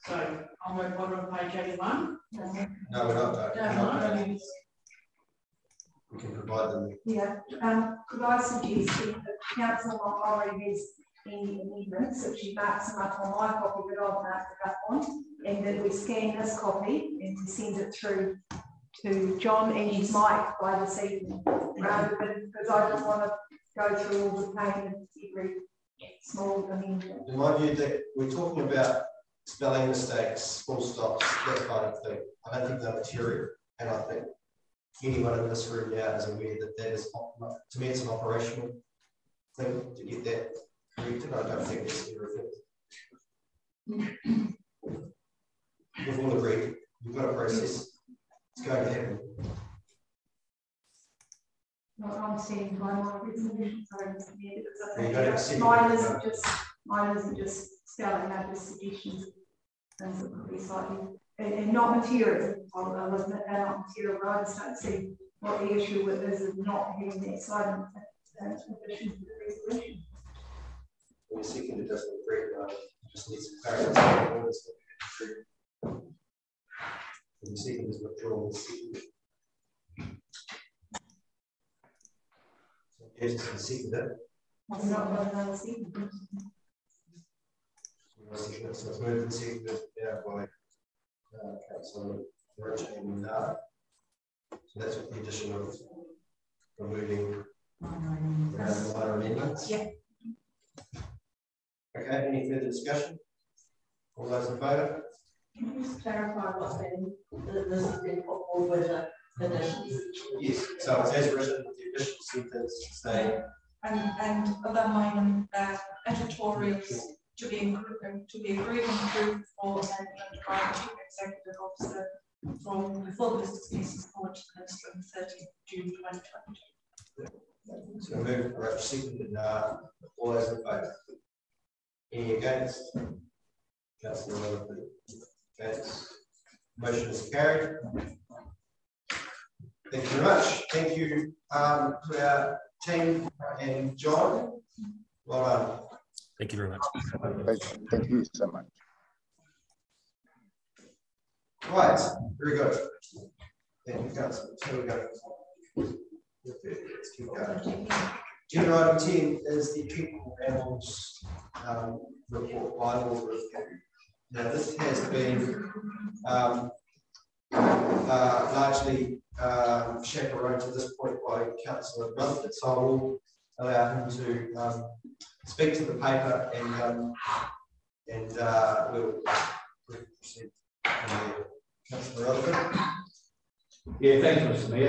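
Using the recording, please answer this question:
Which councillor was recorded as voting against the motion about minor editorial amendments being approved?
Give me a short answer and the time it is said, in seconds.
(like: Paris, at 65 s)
Councillor Willoughby, at 134 s.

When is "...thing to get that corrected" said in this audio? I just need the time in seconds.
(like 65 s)
39 s.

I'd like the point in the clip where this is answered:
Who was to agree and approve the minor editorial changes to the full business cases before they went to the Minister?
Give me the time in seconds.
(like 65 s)
120 s.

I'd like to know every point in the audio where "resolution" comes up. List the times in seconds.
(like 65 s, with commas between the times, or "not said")
53 s, 69 s.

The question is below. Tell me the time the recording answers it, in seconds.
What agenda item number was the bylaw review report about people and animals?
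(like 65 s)
159 s.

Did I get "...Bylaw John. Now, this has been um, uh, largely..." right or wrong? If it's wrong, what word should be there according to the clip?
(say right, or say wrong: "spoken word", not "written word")
wrong: "Review", not "John".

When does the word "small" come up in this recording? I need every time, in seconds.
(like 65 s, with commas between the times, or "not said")
26 s.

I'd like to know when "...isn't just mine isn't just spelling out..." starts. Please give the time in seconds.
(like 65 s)
55 s.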